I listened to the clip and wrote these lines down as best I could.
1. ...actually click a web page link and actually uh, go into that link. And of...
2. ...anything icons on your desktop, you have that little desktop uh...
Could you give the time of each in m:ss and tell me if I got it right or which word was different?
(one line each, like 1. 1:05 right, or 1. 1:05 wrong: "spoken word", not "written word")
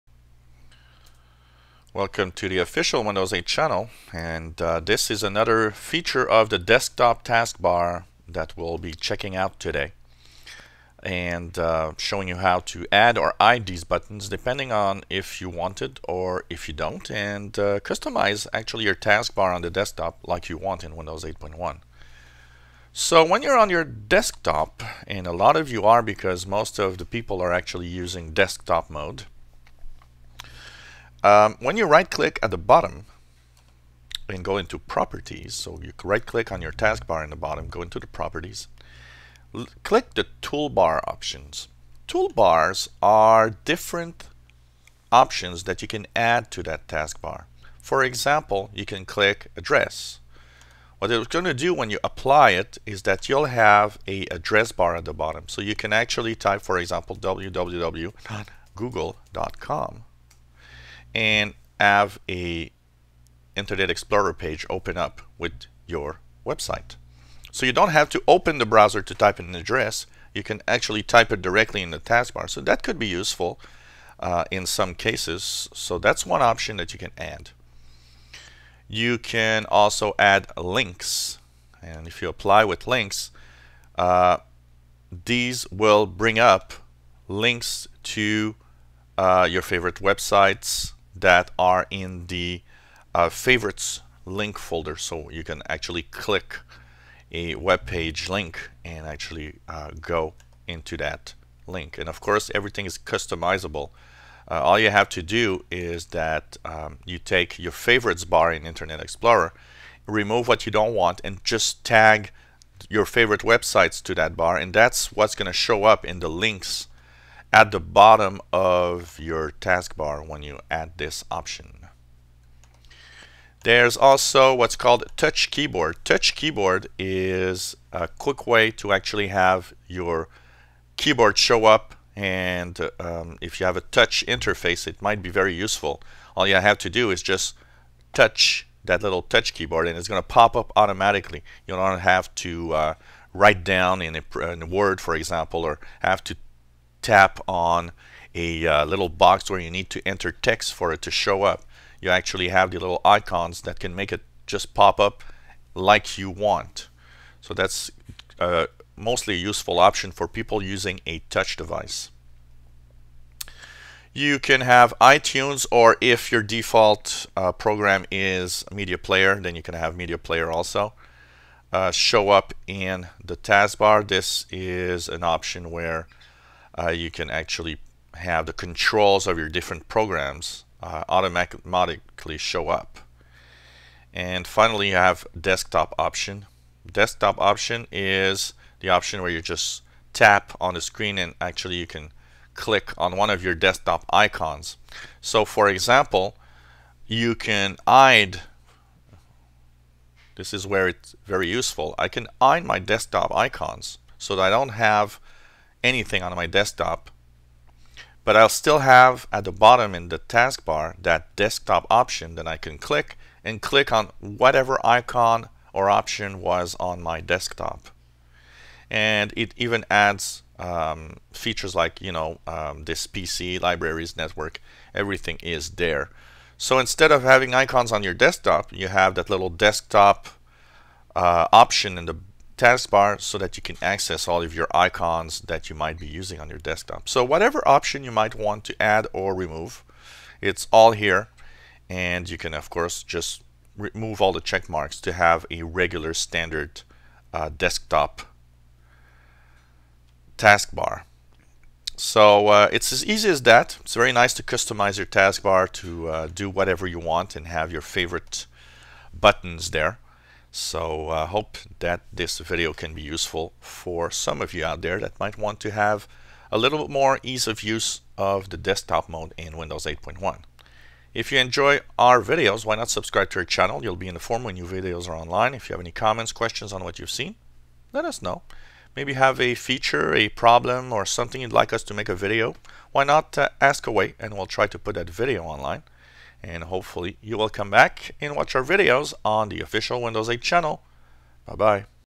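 1. 1:35 right
2. 3:47 wrong: "having", not "anything".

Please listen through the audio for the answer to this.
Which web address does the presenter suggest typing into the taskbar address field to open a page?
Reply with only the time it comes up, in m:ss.
0:57.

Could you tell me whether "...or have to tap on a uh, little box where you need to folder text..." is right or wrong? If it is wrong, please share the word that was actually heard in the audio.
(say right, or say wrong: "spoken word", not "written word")
wrong: "enter", not "folder".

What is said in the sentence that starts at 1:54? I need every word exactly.
And that's what's going to show up in the links at the bottom of your taskbar when you add this option.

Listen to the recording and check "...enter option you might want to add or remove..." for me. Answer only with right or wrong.
wrong.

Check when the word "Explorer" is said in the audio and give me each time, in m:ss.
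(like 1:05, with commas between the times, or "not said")
1:03, 1:48.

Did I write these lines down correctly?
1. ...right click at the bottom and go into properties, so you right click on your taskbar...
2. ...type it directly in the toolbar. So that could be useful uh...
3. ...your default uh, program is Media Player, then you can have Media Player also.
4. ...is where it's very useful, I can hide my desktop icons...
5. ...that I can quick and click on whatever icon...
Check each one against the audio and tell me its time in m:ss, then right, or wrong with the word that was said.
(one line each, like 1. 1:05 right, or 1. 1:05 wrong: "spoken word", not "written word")
1. 0:31 right
2. 1:11 wrong: "taskbar", not "toolbar"
3. 2:46 right
4. 3:20 right
5. 3:32 wrong: "click", not "quick".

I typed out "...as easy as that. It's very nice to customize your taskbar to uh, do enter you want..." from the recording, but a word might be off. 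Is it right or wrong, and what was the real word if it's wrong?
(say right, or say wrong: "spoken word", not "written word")
wrong: "whatever", not "enter".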